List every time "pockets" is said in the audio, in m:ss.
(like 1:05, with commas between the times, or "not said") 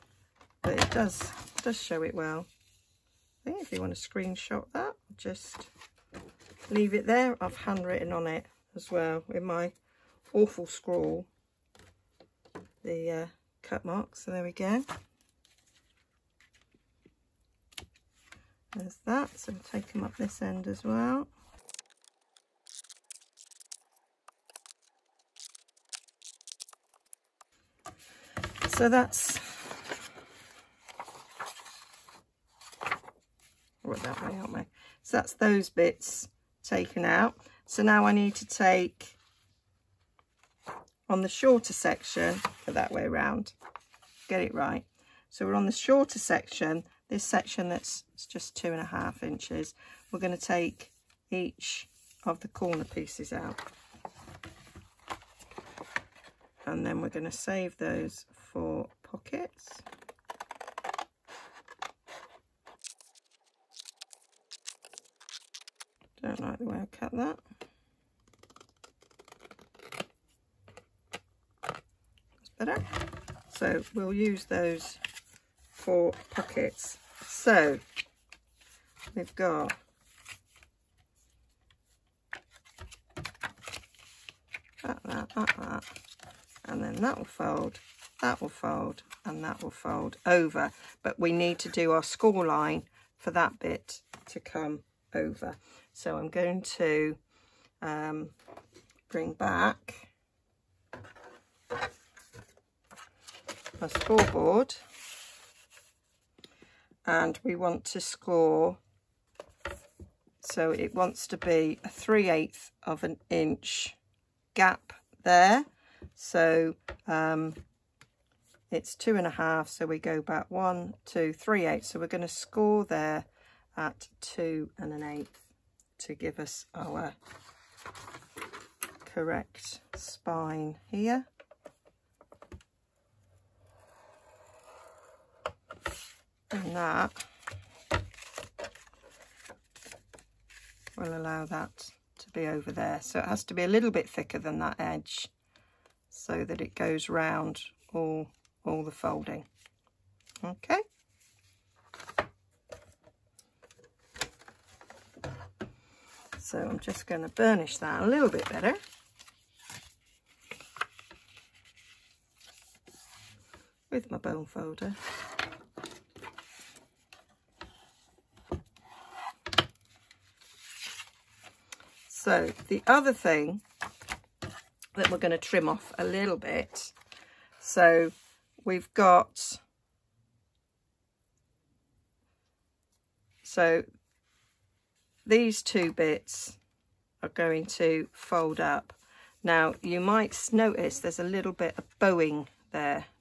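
0:59, 1:16.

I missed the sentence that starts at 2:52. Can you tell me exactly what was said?
So the other thing that we're going to trim off a little bit.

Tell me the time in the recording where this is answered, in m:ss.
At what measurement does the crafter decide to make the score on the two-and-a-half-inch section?
2:04.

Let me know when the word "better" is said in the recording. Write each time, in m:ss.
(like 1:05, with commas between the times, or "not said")
1:12, 2:38.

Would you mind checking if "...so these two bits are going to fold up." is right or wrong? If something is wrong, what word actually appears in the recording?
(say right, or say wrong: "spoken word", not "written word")
right.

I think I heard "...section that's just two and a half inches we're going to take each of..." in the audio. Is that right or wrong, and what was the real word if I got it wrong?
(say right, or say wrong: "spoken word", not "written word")
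right.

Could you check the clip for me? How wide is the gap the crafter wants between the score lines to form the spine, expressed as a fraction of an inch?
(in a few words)
3/8 inch.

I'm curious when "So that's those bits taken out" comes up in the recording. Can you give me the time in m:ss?
0:35.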